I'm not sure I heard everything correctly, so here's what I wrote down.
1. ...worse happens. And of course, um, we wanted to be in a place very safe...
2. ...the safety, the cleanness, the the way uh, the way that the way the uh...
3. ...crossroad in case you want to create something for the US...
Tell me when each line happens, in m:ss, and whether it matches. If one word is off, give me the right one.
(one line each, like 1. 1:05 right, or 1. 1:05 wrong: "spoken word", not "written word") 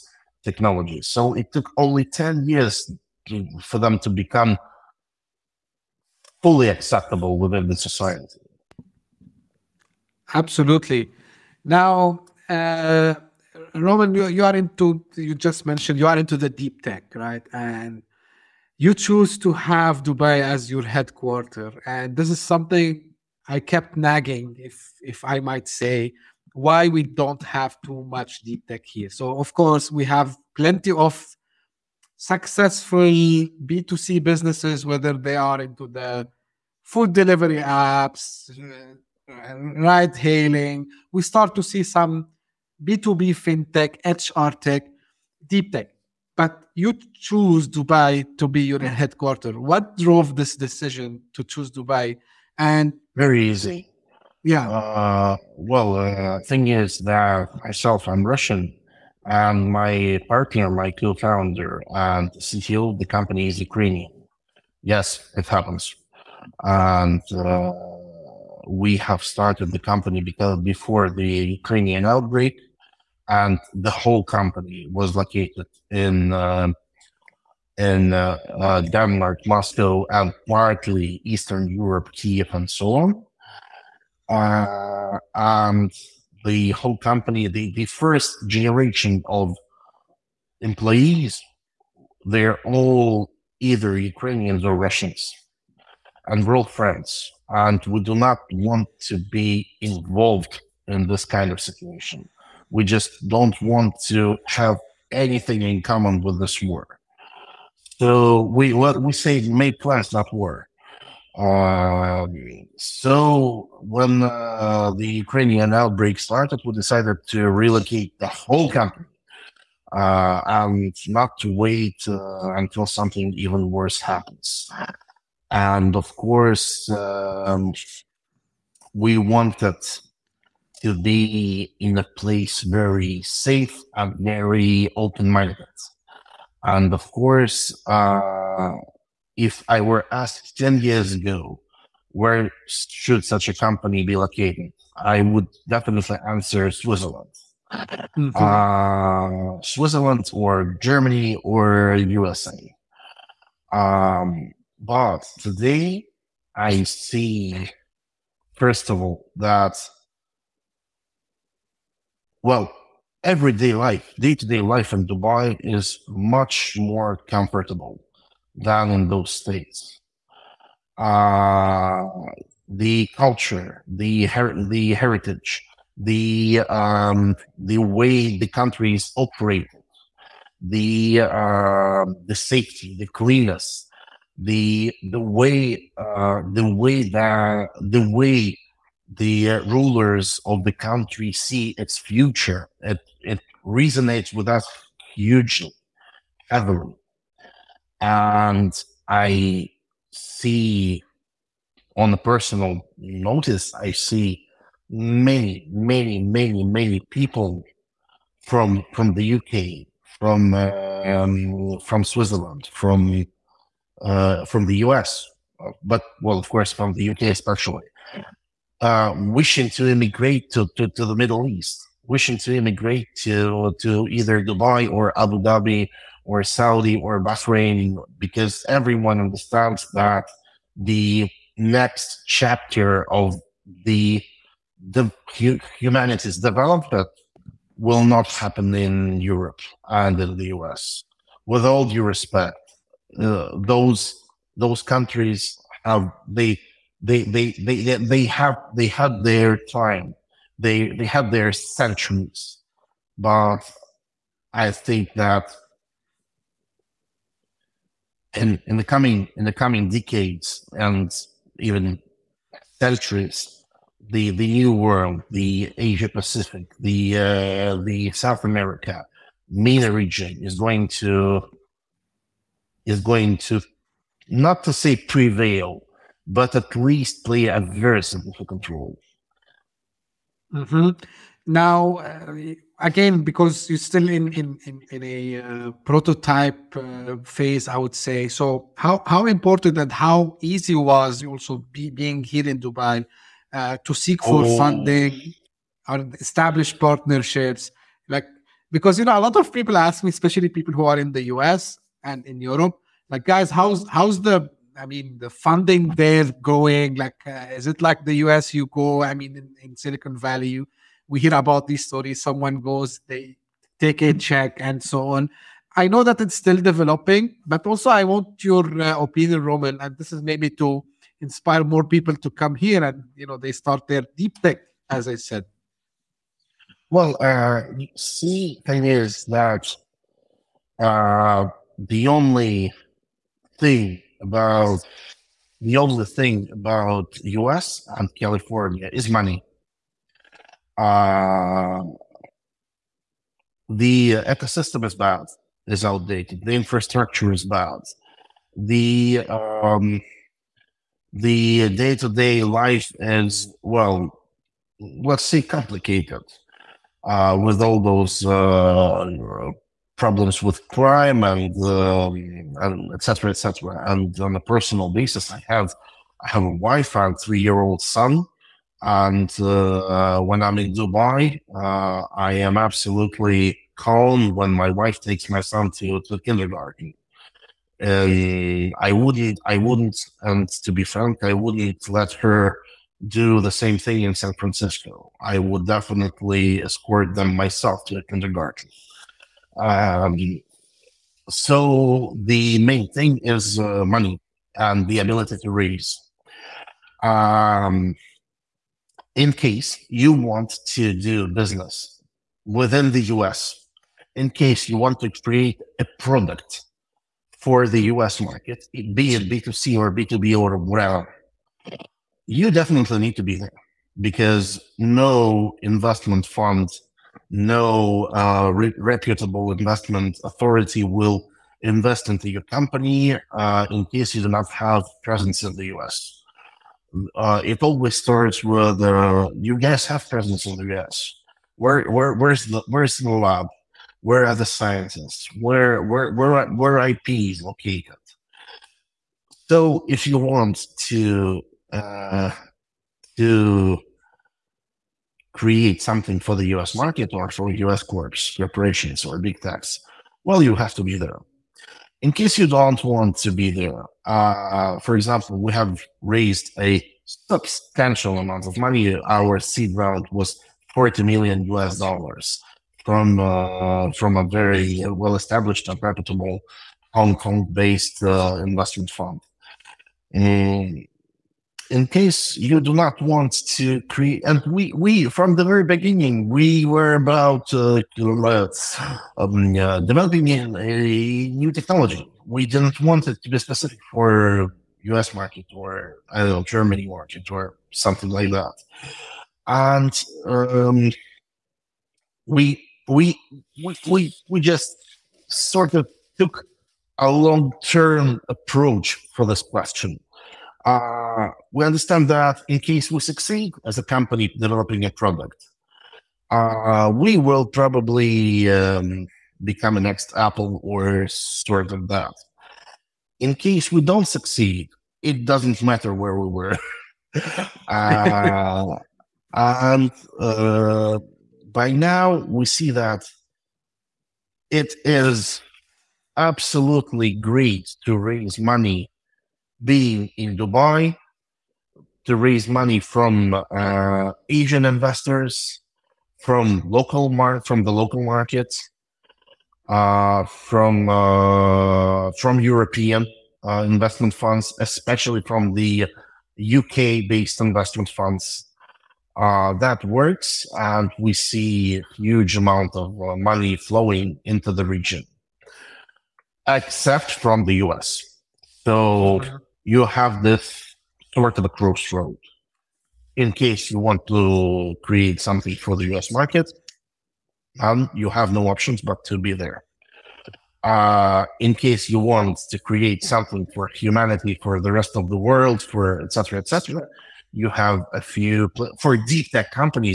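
1. 2:03 right
2. 3:02 right
3. 9:21 right.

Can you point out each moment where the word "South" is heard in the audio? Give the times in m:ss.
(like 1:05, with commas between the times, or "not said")
4:28.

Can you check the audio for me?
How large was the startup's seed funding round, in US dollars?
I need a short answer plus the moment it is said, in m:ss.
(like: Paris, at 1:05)
40 million US dollars, at 7:40.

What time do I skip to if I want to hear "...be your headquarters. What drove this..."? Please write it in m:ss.
0:48.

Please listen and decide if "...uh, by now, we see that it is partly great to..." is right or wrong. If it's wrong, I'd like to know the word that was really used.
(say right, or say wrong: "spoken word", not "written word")
wrong: "absolutely", not "partly".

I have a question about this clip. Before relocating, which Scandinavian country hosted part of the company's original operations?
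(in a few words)
Denmark.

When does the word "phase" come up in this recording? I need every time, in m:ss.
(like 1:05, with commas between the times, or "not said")
4:47.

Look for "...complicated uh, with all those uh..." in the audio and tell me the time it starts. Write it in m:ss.
5:55.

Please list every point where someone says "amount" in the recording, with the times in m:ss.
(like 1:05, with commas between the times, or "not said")
7:38, 9:12.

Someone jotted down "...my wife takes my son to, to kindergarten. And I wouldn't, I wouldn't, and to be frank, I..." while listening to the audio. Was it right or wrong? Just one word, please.
right.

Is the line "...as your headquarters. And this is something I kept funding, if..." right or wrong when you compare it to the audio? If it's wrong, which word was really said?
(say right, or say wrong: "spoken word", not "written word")
wrong: "nagging", not "funding".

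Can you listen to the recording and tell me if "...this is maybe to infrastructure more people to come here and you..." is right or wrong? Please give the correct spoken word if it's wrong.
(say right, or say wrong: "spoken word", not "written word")
wrong: "inspire", not "infrastructure".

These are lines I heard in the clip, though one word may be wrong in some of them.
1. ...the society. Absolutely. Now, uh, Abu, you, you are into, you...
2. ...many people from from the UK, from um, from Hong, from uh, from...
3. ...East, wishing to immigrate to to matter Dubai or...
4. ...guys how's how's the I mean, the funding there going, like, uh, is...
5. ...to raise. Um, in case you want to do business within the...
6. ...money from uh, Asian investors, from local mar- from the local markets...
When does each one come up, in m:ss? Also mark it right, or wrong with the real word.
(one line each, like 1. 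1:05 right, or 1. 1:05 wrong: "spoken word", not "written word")
1. 0:07 wrong: "Roman", not "Abu"
2. 3:26 wrong: "Switzerland", not "Hong"
3. 3:41 wrong: "either", not "matter"
4. 5:03 right
5. 6:35 right
6. 8:52 right.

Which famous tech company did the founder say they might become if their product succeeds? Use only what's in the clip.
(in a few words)
Apple.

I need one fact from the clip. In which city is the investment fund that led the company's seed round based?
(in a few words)
Hong Kong.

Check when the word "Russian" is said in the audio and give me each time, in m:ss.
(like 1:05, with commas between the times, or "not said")
0:58, 1:34.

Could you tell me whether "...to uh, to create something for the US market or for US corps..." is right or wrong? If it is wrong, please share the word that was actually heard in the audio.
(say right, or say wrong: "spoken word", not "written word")
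right.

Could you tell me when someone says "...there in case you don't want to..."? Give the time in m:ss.
7:30.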